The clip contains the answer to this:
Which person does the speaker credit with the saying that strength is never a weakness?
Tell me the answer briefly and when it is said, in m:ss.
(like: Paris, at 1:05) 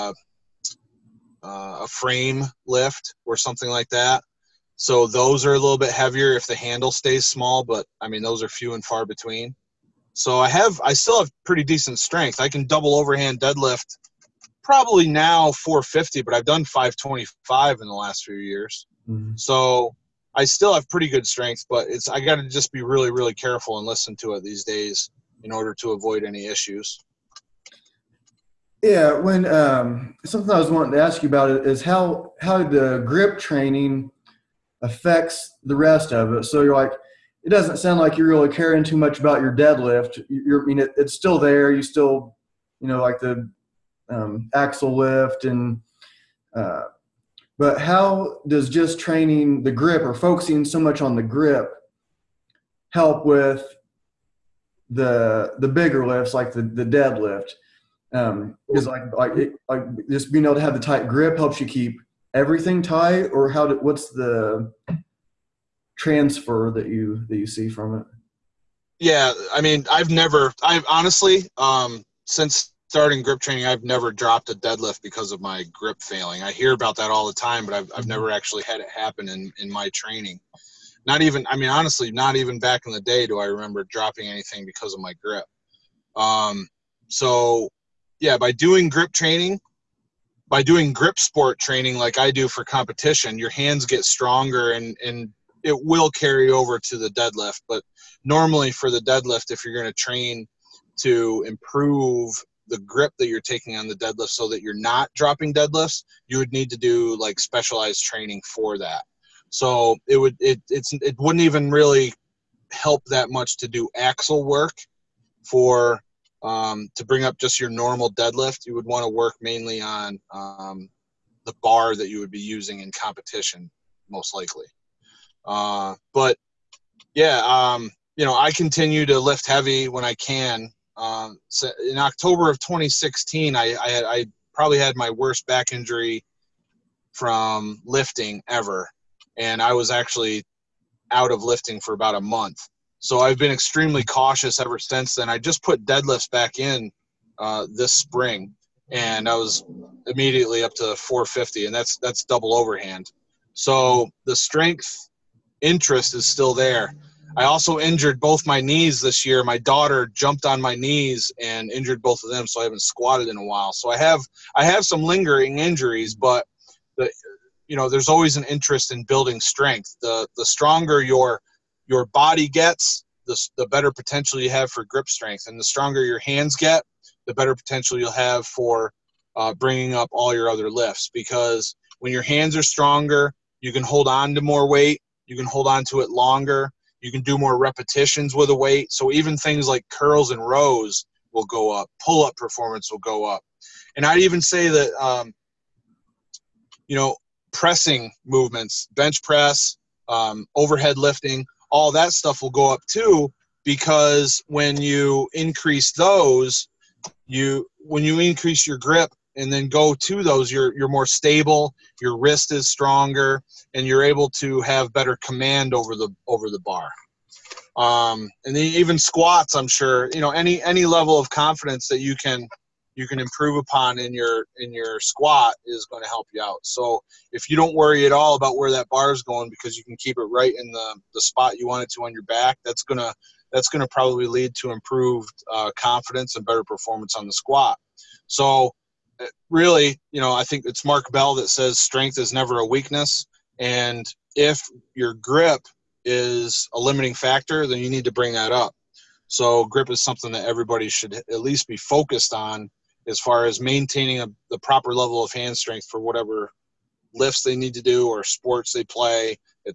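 Mark Bell, at 4:00.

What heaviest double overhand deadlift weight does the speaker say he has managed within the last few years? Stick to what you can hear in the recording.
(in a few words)
525.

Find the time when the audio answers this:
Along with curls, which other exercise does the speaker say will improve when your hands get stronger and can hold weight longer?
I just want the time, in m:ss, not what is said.
3:10.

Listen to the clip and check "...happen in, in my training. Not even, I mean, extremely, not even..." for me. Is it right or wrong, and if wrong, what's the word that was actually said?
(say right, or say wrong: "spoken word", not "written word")
wrong: "honestly", not "extremely".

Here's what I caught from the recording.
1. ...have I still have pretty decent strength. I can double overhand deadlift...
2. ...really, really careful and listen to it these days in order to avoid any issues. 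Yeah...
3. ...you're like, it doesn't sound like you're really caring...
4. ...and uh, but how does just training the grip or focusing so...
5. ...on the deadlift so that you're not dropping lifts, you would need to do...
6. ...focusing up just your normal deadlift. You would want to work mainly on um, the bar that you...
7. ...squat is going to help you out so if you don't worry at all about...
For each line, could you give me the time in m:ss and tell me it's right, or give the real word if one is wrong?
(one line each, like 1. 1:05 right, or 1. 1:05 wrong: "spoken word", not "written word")
1. 0:10 right
2. 0:22 right
3. 0:36 right
4. 0:45 right
5. 1:43 wrong: "deadlifts", not "lifts"
6. 1:57 wrong: "bring", not "focusing"
7. 3:44 right.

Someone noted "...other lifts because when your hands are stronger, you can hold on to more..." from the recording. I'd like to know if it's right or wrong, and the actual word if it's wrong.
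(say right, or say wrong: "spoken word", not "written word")
right.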